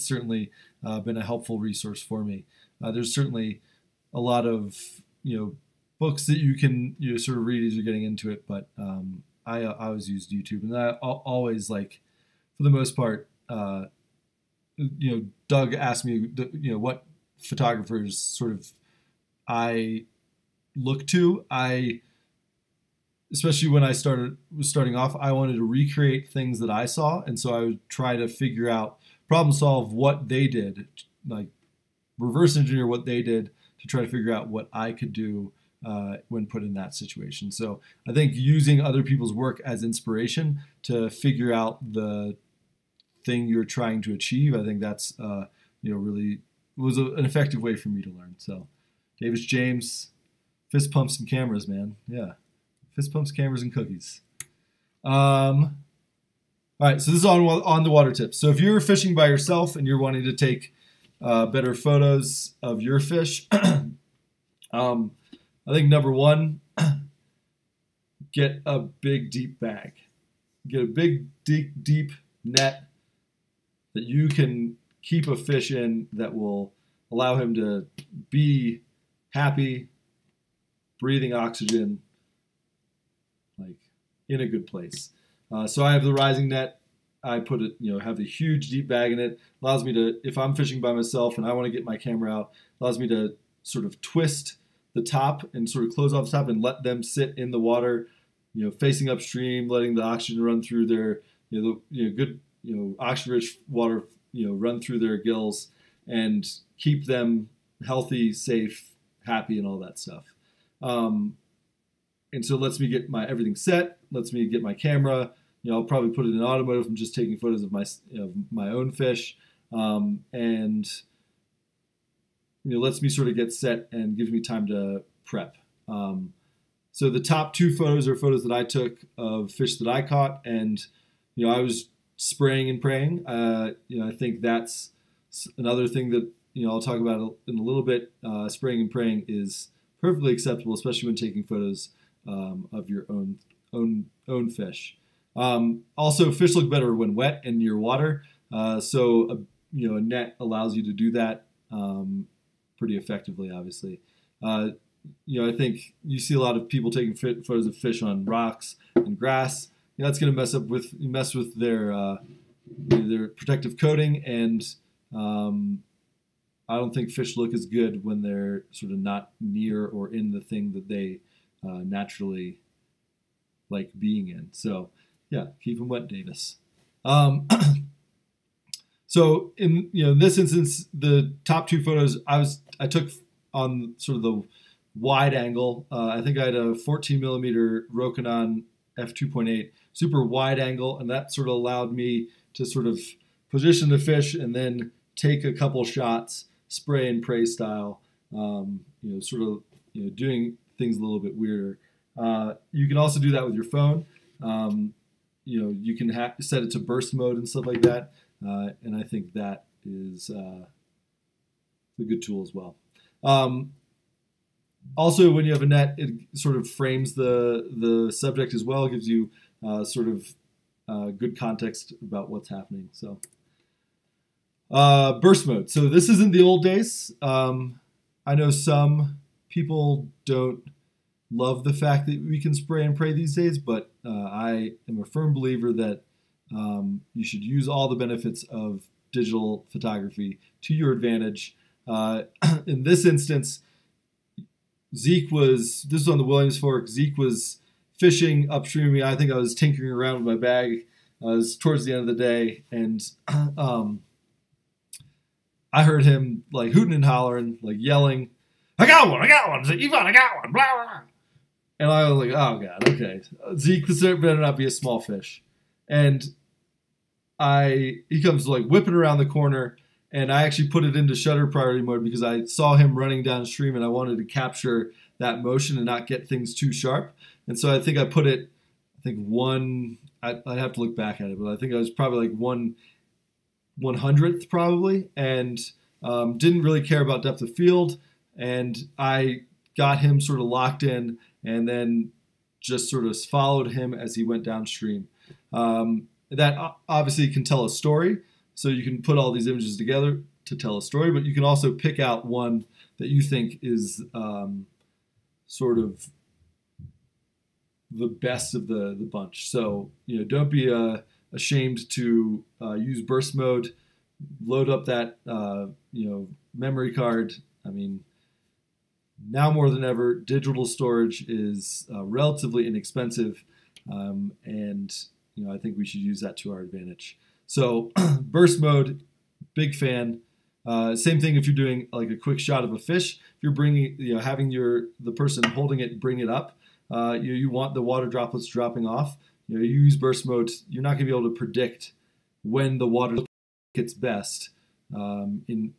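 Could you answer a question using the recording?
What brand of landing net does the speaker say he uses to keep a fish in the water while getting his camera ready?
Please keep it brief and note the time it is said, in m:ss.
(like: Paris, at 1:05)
Rising, at 1:26.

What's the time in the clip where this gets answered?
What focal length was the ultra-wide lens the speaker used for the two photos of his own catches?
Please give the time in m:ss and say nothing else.
3:06.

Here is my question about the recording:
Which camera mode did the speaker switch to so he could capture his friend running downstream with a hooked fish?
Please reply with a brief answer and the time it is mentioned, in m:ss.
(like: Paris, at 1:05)
Shutter priority, at 4:31.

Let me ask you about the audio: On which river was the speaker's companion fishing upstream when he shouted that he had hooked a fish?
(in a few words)
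Williams Fork.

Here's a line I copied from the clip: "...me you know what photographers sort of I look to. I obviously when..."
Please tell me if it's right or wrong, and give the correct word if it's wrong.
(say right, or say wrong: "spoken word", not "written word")
wrong: "especially", not "obviously".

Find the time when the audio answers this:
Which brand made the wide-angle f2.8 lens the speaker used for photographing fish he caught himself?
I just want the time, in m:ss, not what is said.
3:07.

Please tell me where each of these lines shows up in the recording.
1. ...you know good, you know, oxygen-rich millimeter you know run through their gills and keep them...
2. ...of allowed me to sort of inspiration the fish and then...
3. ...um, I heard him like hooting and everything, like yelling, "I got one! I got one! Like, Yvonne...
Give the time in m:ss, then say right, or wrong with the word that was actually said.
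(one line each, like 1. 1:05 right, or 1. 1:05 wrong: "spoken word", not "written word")
1. 1:41 wrong: "water", not "millimeter"
2. 3:11 wrong: "position", not "inspiration"
3. 4:13 wrong: "hollering", not "everything".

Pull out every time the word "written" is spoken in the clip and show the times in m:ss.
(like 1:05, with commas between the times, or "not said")
not said.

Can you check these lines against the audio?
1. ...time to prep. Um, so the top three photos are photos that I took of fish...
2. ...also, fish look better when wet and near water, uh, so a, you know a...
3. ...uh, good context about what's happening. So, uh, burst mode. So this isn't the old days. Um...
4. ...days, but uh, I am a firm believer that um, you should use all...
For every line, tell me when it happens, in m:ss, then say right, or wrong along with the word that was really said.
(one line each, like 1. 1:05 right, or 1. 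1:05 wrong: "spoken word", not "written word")
1. 2:04 wrong: "two", not "three"
2. 2:25 right
3. 3:40 right
4. 3:53 right.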